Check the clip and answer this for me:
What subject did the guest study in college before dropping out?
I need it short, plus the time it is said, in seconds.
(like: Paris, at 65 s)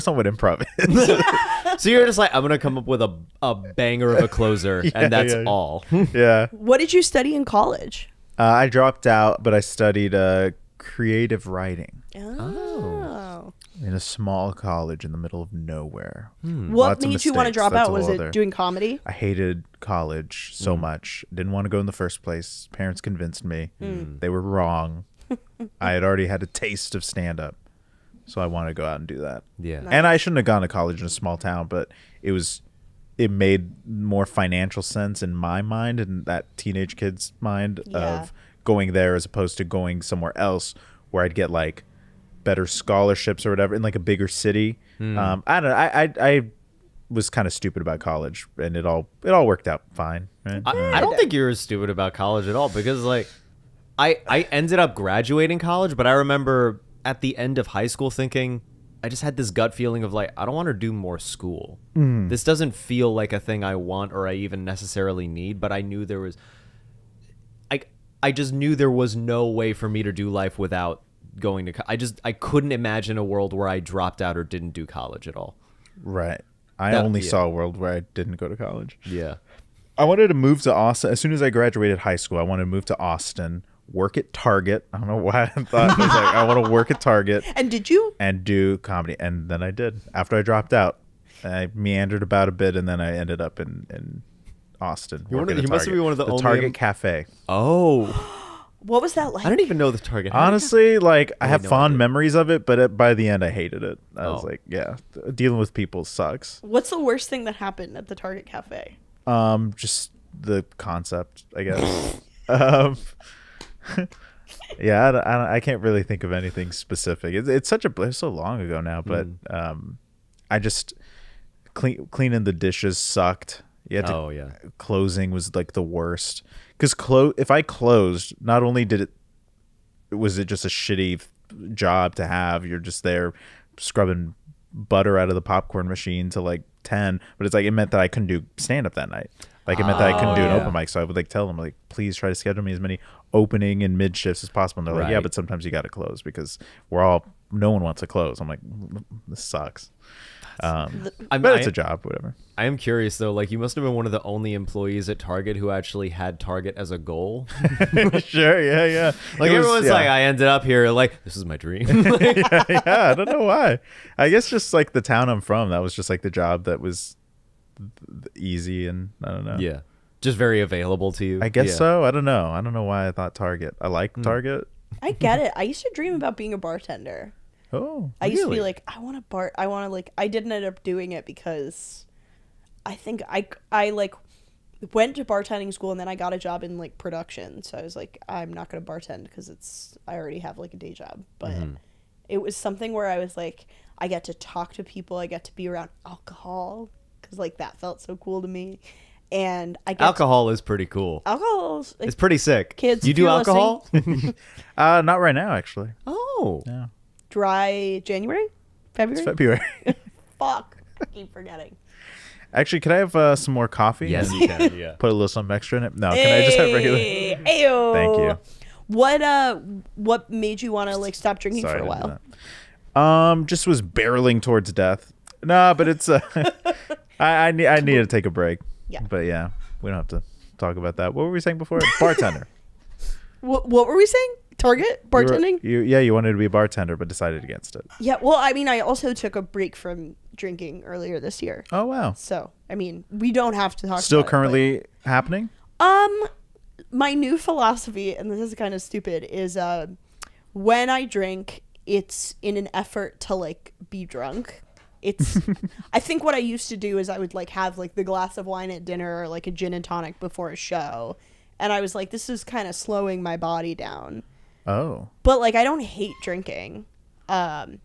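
Creative writing, at 10 s.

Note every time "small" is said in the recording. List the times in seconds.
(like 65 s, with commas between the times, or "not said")
13 s, 31 s.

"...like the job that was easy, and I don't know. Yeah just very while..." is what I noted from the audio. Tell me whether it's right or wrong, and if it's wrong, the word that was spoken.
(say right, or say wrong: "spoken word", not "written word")
wrong: "available", not "while".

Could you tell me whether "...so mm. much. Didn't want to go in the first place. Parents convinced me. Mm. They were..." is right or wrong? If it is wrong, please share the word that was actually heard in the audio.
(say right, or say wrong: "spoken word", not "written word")
right.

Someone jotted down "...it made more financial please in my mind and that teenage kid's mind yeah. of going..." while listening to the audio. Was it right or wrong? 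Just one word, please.
wrong.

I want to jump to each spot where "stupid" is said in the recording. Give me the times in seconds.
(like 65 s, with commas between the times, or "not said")
47 s, 51 s, 248 s.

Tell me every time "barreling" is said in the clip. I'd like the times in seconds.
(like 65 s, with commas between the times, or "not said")
223 s.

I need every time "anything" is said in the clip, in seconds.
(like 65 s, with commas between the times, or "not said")
116 s.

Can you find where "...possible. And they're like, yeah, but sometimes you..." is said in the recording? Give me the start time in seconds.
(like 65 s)
144 s.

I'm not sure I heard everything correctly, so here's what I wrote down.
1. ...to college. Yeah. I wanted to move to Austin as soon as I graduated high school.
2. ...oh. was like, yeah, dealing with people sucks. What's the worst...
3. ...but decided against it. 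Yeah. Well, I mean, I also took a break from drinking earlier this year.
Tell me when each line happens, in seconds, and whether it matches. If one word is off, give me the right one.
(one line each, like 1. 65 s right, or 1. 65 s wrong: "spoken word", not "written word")
1. 78 s right
2. 104 s right
3. 236 s right.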